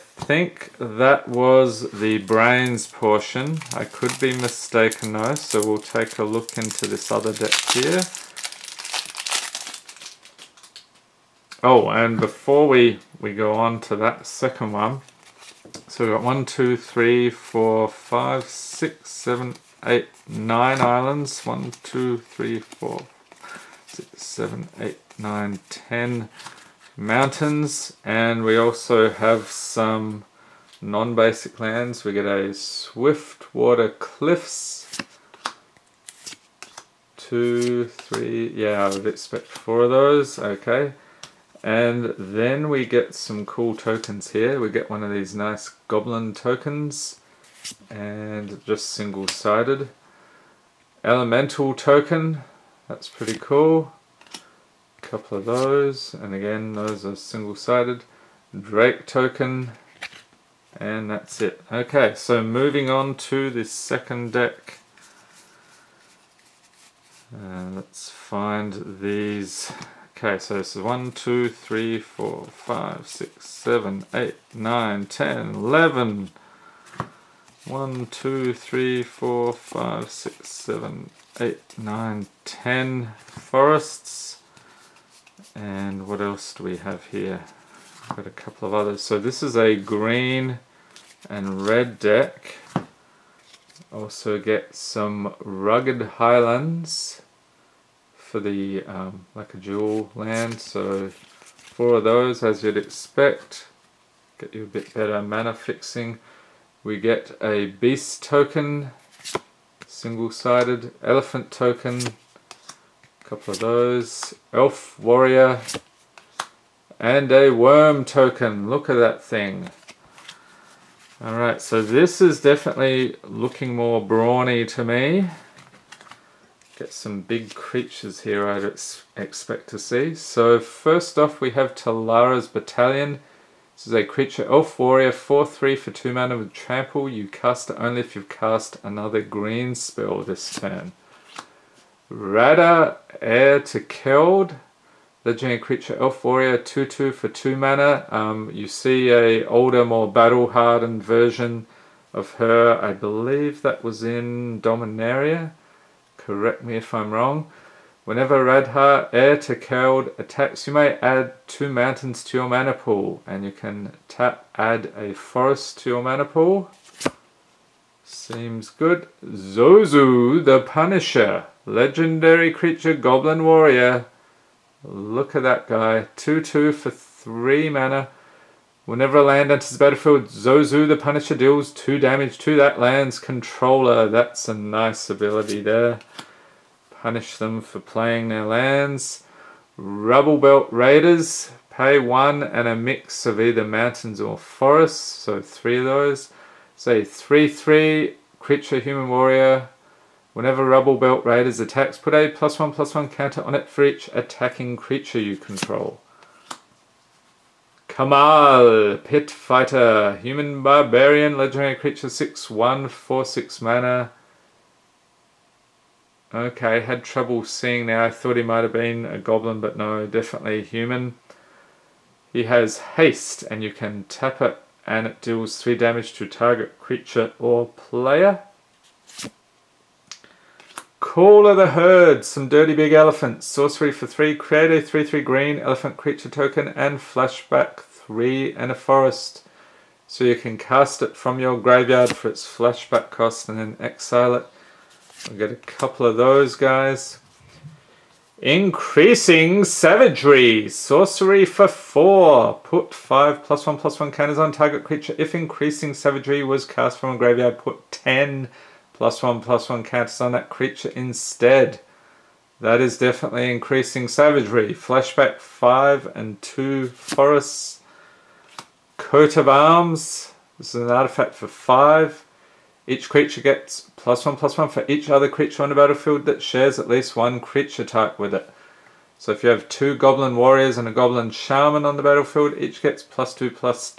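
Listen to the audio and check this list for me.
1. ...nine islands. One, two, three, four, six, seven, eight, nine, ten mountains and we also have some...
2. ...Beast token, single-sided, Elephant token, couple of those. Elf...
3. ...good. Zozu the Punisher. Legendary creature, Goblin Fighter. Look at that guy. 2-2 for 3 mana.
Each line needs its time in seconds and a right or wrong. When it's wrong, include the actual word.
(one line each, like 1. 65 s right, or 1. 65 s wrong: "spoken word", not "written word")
1. 20 s right
2. 107 s right
3. 168 s wrong: "Warrior", not "Fighter".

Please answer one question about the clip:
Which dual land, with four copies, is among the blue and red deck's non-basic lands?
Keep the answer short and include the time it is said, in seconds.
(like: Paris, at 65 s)
Swiftwater Cliffs, at 32 s.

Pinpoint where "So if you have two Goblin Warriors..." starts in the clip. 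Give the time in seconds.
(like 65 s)
279 s.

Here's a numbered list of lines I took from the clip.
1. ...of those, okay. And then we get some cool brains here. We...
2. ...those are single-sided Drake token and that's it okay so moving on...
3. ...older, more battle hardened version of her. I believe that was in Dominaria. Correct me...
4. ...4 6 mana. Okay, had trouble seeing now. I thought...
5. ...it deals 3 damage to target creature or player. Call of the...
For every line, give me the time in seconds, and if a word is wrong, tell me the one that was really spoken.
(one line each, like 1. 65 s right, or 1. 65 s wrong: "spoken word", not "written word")
1. 39 s wrong: "tokens", not "brains"
2. 56 s right
3. 149 s right
4. 212 s right
5. 225 s right.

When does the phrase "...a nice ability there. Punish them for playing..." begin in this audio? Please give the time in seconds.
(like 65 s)
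184 s.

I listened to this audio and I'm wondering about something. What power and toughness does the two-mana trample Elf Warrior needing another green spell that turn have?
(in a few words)
4/3.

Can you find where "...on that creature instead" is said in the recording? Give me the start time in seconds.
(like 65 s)
260 s.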